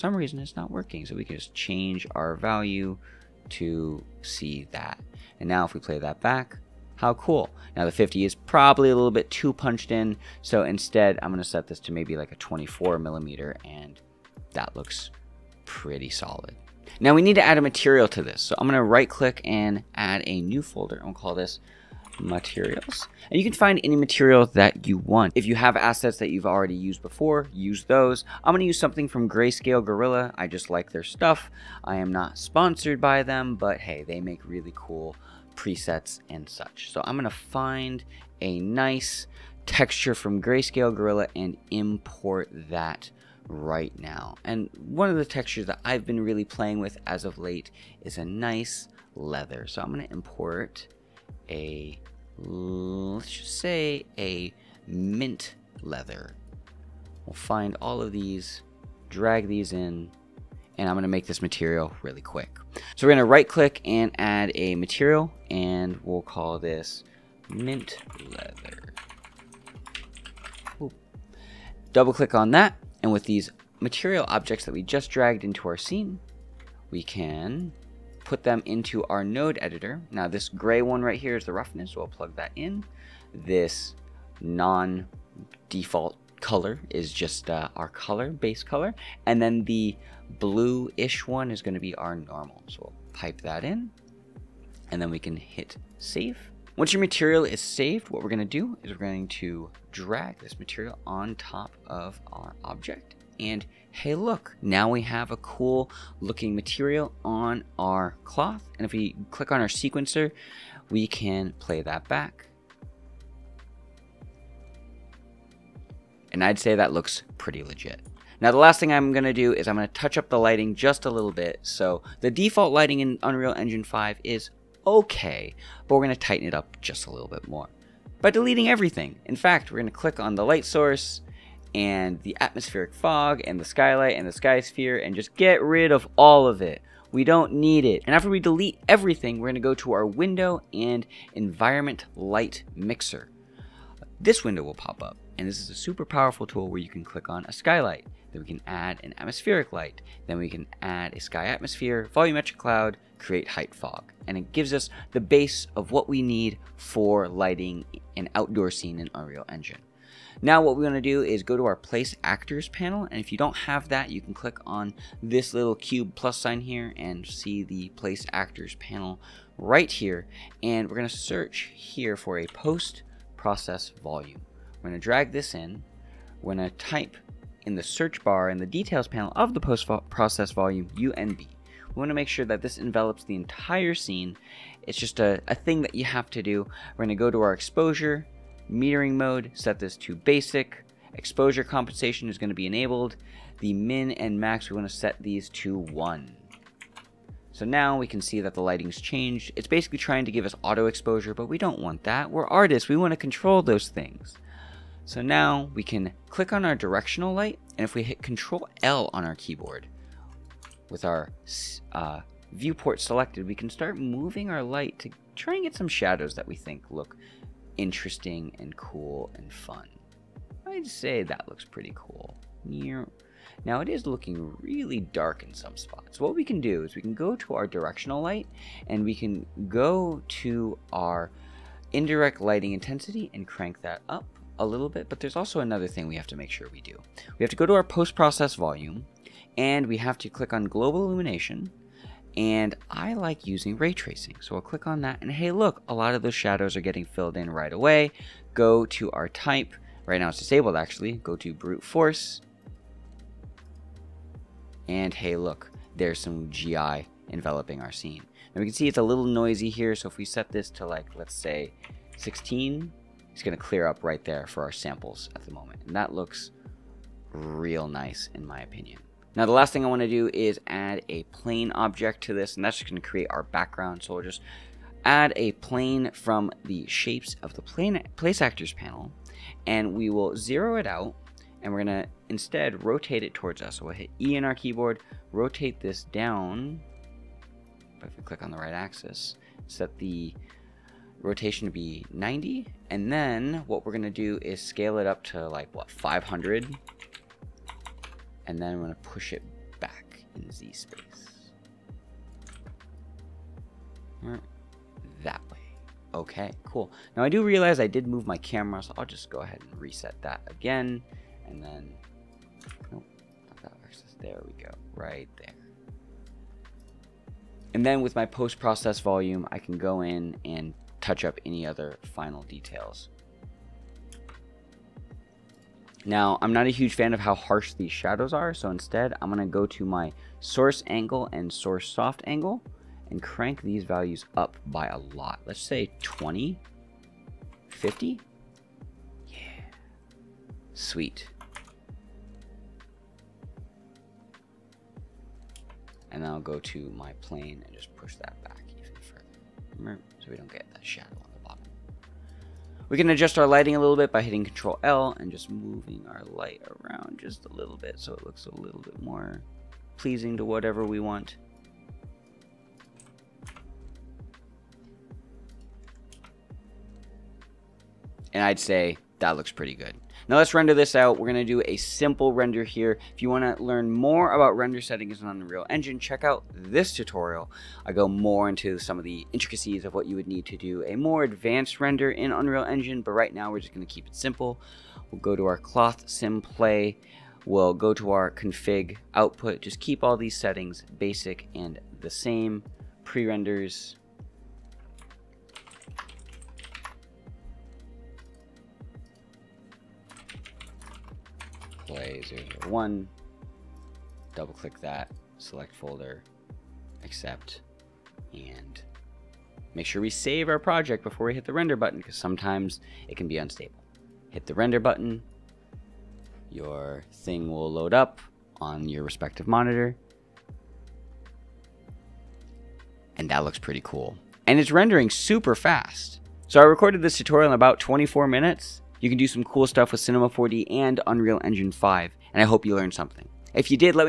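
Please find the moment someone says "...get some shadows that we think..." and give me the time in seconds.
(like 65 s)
215 s.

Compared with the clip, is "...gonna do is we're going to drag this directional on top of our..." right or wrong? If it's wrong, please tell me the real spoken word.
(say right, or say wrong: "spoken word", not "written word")
wrong: "material", not "directional".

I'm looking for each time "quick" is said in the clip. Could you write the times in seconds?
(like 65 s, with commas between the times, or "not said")
62 s.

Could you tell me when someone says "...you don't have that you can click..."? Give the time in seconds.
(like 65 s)
163 s.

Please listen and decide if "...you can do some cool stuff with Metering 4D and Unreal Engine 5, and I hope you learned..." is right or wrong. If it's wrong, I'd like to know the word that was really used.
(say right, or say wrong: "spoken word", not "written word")
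wrong: "Cinema", not "Metering".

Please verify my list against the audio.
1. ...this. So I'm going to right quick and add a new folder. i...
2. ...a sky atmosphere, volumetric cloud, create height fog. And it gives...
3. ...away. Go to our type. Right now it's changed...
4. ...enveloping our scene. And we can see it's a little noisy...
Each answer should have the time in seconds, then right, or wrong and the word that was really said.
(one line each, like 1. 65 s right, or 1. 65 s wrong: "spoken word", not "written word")
1. 18 s wrong: "click", not "quick"
2. 151 s right
3. 247 s wrong: "disabled", not "changed"
4. 257 s right.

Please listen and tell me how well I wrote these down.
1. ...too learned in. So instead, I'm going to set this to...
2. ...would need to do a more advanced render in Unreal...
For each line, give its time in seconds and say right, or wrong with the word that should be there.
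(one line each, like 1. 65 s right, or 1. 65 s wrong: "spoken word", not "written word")
1. 9 s wrong: "punched", not "learned"
2. 380 s right.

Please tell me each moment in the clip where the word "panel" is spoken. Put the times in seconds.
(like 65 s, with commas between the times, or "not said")
162 s, 168 s, 179 s, 278 s.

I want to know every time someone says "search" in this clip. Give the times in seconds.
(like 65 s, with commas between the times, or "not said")
171 s, 177 s.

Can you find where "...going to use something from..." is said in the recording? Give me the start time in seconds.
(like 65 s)
28 s.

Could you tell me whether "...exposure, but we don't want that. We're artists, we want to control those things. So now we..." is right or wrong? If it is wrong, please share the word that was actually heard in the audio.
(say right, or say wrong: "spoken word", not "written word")
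right.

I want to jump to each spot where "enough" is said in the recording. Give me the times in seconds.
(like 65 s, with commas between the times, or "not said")
not said.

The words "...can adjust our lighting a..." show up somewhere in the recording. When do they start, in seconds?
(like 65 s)
352 s.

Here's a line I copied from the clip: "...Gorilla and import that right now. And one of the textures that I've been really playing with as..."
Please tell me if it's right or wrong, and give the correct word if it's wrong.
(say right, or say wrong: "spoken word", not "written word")
right.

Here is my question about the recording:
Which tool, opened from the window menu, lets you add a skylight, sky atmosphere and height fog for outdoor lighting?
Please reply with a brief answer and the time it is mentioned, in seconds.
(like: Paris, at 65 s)
environment light mixer, at 141 s.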